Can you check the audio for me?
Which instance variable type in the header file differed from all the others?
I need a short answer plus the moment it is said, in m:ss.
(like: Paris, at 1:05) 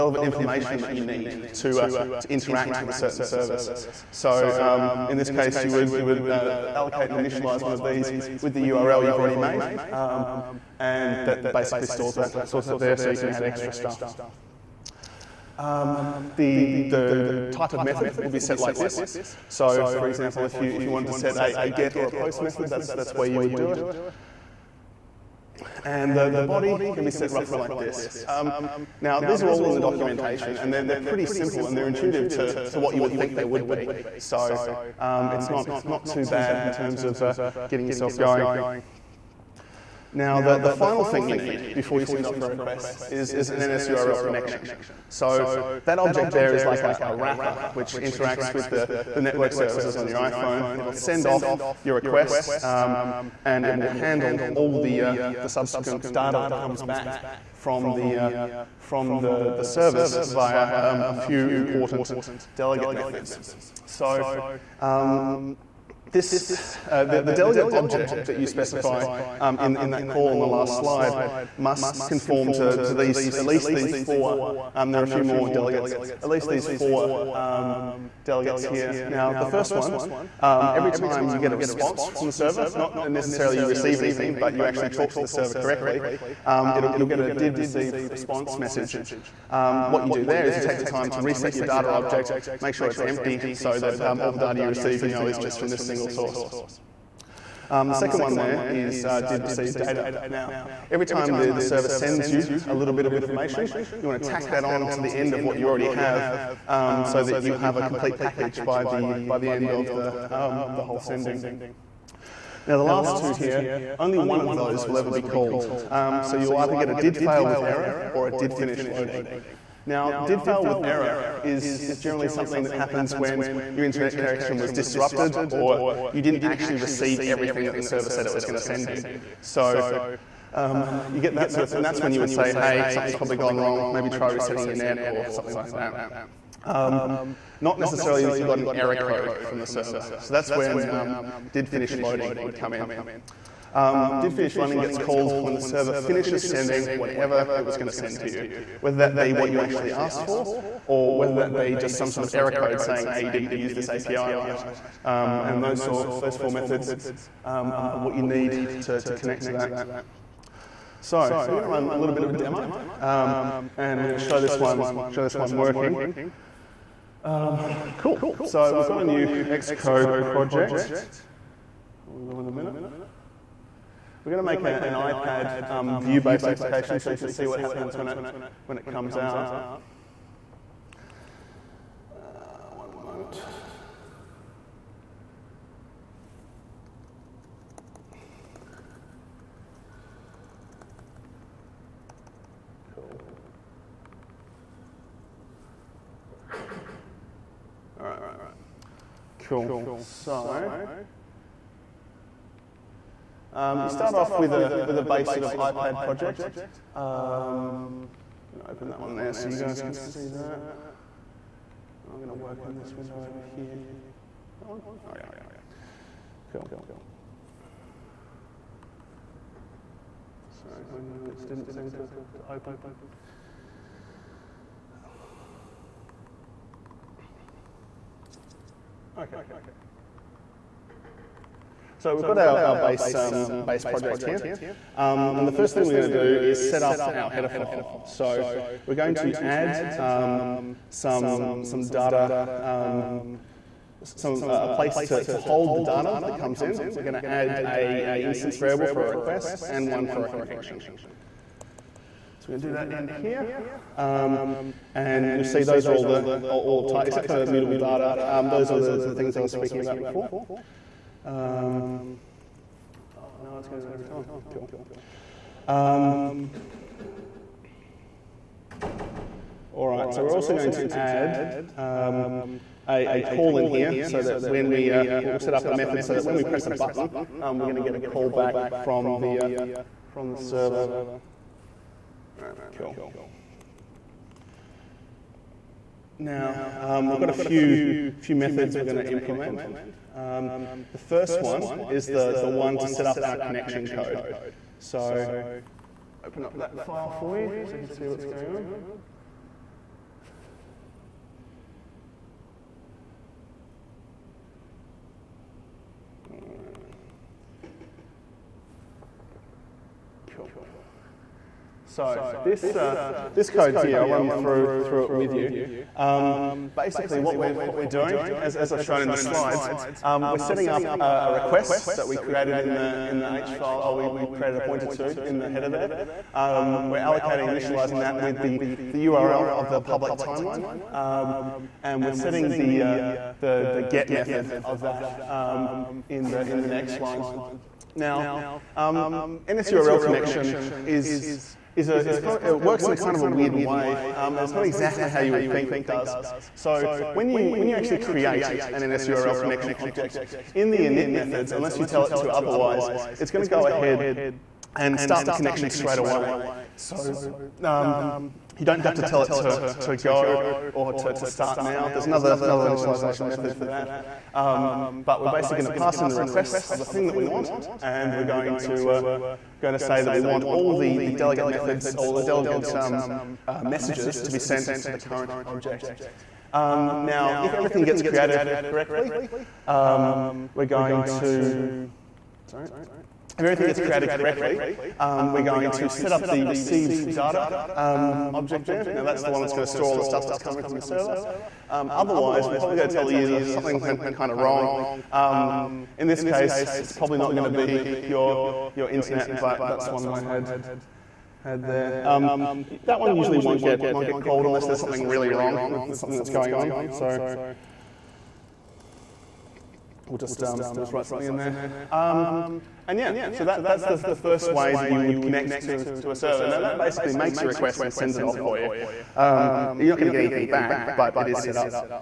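mutable data, at 4:17.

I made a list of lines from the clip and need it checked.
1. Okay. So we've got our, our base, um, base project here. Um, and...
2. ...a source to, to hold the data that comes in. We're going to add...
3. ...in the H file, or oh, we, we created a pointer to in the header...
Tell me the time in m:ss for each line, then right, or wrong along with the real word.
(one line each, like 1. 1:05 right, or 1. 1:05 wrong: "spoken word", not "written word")
1. 3:49 right
2. 4:04 wrong: "place", not "source"
3. 5:23 right.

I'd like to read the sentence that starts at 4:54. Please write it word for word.
So open up that file for you so you can see what's going on.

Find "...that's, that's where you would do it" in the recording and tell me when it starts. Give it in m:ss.
0:22.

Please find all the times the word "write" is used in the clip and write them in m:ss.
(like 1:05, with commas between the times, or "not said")
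6:50.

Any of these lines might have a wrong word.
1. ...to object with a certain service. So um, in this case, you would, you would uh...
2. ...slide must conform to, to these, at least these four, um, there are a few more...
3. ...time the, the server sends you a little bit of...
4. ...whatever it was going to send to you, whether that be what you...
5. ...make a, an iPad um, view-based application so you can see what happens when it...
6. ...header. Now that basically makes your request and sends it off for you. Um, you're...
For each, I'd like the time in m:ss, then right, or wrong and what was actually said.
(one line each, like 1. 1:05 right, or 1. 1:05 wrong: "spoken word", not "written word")
1. 0:02 wrong: "interact", not "object"
2. 1:10 right
3. 1:41 right
4. 2:26 right
5. 2:54 right
6. 6:56 wrong: "server", not "header".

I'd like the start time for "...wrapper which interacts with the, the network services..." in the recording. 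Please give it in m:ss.
0:47.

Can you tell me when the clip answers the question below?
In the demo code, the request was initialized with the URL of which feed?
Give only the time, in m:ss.
5:29.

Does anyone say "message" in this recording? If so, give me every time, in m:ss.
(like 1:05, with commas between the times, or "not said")
1:28, 6:13.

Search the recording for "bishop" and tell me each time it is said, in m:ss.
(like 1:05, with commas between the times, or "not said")
not said.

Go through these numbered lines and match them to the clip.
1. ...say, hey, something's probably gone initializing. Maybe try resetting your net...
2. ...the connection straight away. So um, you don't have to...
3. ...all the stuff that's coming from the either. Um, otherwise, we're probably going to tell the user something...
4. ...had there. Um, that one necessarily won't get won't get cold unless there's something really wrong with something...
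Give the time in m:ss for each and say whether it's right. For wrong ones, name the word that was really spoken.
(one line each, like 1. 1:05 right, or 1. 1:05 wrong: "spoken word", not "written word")
1. 2:12 wrong: "wrong", not "initializing"
2. 5:55 right
3. 6:29 wrong: "server", not "either"
4. 6:41 wrong: "usually", not "necessarily".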